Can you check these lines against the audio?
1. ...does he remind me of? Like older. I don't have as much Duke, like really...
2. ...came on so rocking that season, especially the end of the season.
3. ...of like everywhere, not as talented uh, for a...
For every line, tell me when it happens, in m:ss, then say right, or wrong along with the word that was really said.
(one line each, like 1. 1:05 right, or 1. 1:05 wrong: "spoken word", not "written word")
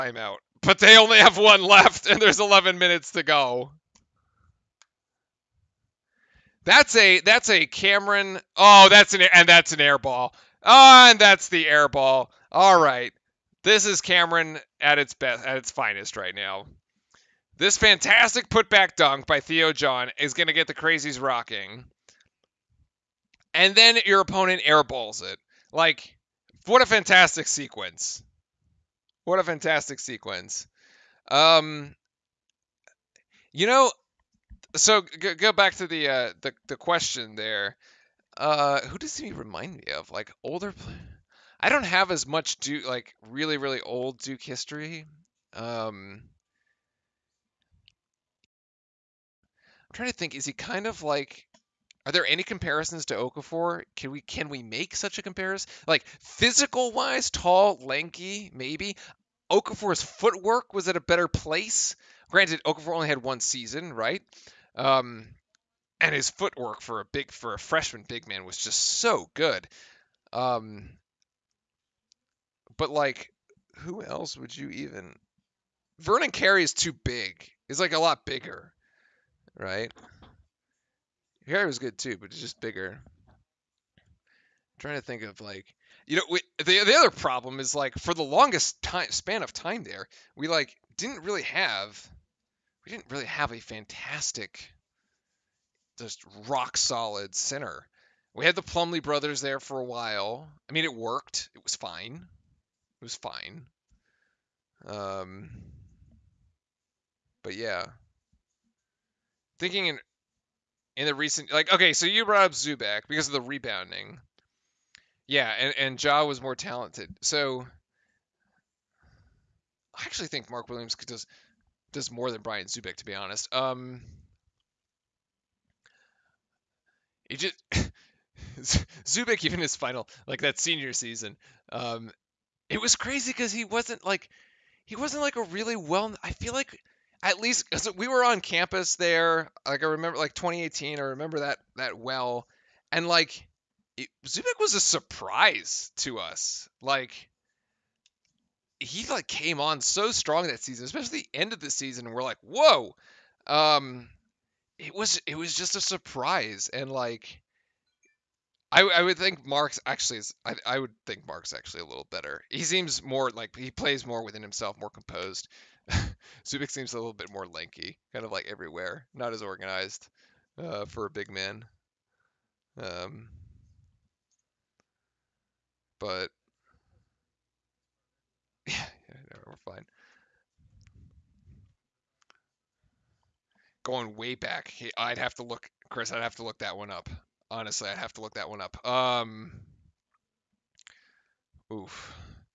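1. 0:38 right
2. 2:29 wrong: "strong", not "rocking"
3. 2:48 wrong: "organized", not "talented".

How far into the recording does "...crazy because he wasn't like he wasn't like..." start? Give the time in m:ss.
2:12.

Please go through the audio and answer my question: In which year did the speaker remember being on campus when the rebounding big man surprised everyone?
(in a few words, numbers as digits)
2018.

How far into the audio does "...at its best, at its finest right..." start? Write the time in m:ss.
0:14.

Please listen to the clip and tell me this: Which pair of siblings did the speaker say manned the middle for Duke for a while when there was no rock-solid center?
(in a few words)
The Plumlee brothers.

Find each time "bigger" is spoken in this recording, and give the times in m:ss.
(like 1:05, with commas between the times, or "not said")
1:18, 1:22.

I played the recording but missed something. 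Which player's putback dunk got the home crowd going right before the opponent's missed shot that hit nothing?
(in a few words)
Theo John.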